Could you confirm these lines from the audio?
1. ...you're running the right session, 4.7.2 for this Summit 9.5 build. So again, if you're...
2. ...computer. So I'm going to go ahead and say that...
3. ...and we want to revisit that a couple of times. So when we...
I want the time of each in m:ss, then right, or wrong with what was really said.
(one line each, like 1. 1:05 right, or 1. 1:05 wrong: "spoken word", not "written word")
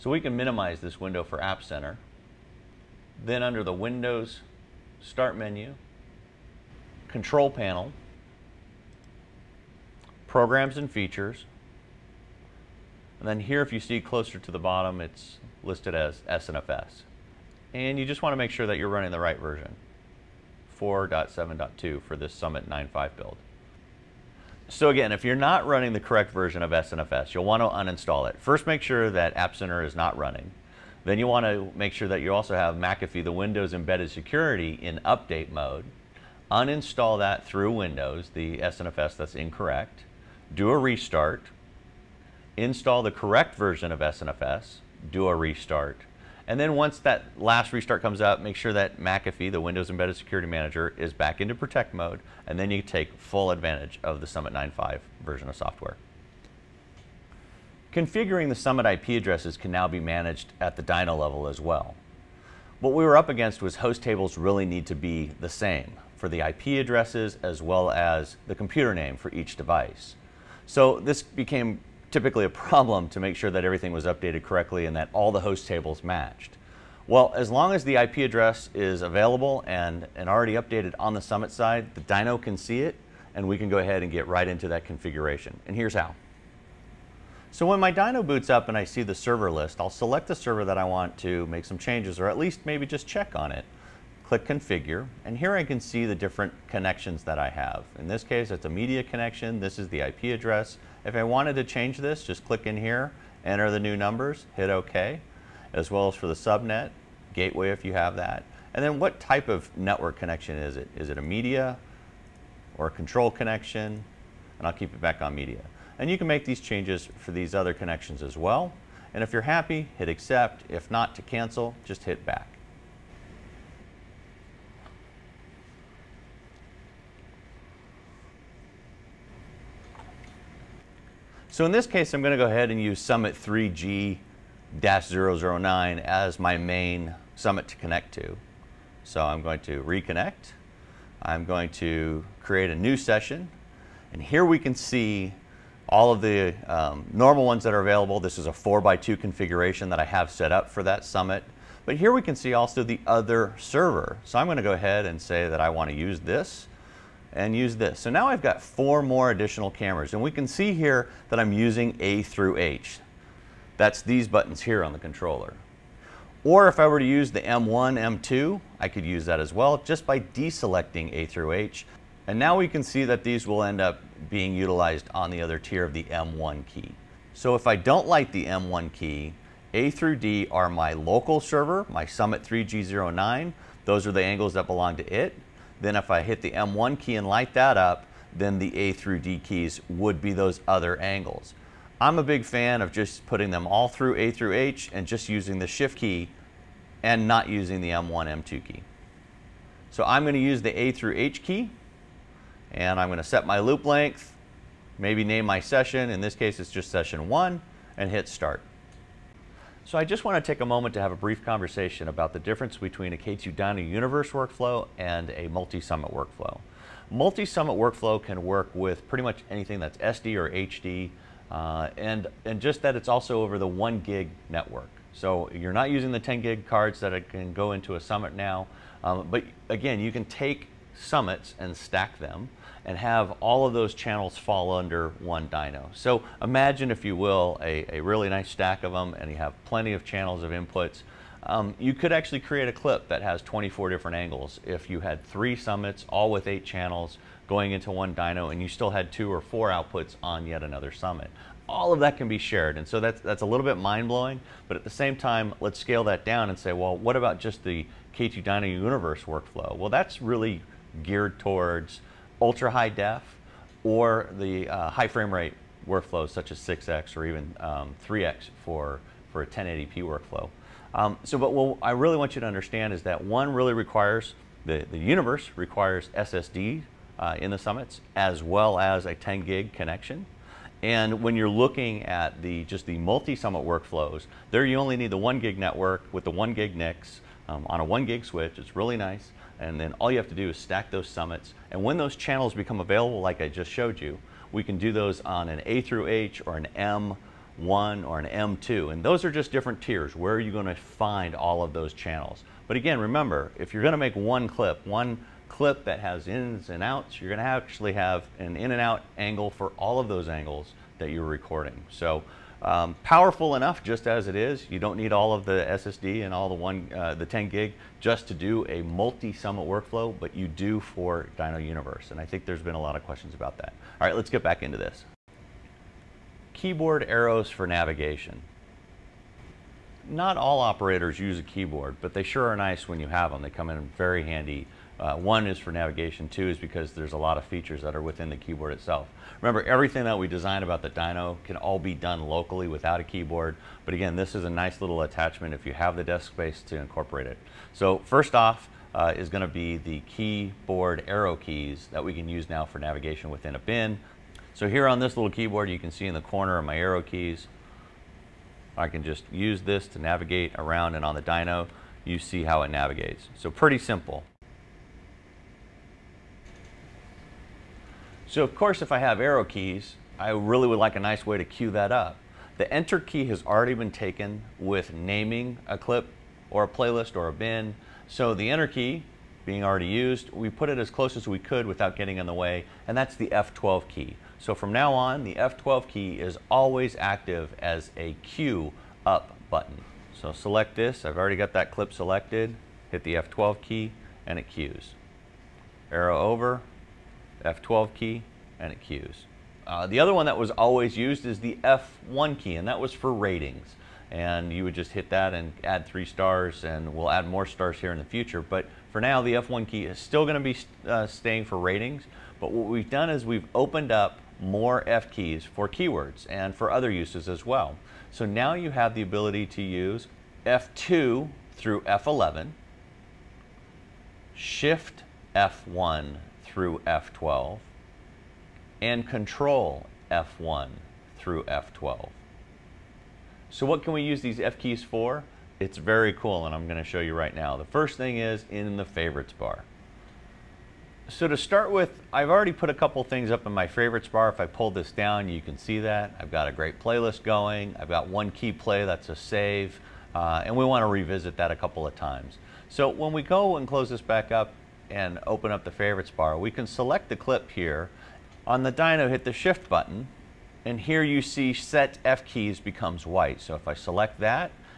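1. 0:18 wrong: "version", not "session"
2. 2:33 wrong: "server", not "computer"
3. 7:30 right.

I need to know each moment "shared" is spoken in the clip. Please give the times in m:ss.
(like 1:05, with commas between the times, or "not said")
4:12.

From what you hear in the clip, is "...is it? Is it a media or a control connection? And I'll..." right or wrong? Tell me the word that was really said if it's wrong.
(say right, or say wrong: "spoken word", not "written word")
right.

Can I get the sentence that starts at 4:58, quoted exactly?
And those are just different tiers.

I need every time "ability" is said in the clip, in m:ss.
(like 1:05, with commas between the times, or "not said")
6:59.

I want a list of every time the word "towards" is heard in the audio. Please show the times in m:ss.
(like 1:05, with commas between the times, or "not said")
4:21.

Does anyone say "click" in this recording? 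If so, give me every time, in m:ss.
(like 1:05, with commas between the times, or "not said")
1:34, 1:42.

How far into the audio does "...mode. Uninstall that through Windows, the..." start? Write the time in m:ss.
0:35.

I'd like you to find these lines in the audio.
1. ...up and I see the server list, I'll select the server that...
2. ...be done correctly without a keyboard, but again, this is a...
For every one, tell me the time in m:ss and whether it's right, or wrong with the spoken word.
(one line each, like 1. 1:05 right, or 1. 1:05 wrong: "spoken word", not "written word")
1. 1:28 right
2. 5:41 wrong: "locally", not "correctly".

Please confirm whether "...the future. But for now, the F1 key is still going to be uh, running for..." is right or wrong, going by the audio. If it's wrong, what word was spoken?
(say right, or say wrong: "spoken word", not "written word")
wrong: "staying", not "running".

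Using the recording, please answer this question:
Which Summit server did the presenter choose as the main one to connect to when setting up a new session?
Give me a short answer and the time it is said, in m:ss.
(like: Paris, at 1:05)
Summit 3G-009, at 2:12.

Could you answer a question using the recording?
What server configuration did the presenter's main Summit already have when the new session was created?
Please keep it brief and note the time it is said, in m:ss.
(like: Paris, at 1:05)
4x2, at 2:28.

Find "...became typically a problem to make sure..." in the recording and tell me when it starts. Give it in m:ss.
1:11.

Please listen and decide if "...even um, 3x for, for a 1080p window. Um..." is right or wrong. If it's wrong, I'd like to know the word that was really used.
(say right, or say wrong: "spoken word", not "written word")
wrong: "workflow", not "window".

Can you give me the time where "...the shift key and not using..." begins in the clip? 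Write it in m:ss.
3:15.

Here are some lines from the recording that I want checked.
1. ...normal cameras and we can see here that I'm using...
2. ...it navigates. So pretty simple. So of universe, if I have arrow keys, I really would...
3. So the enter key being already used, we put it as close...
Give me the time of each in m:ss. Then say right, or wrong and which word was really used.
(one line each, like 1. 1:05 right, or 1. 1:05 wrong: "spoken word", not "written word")
1. 2:39 wrong: "additional", not "normal"
2. 6:02 wrong: "course", not "universe"
3. 6:18 right.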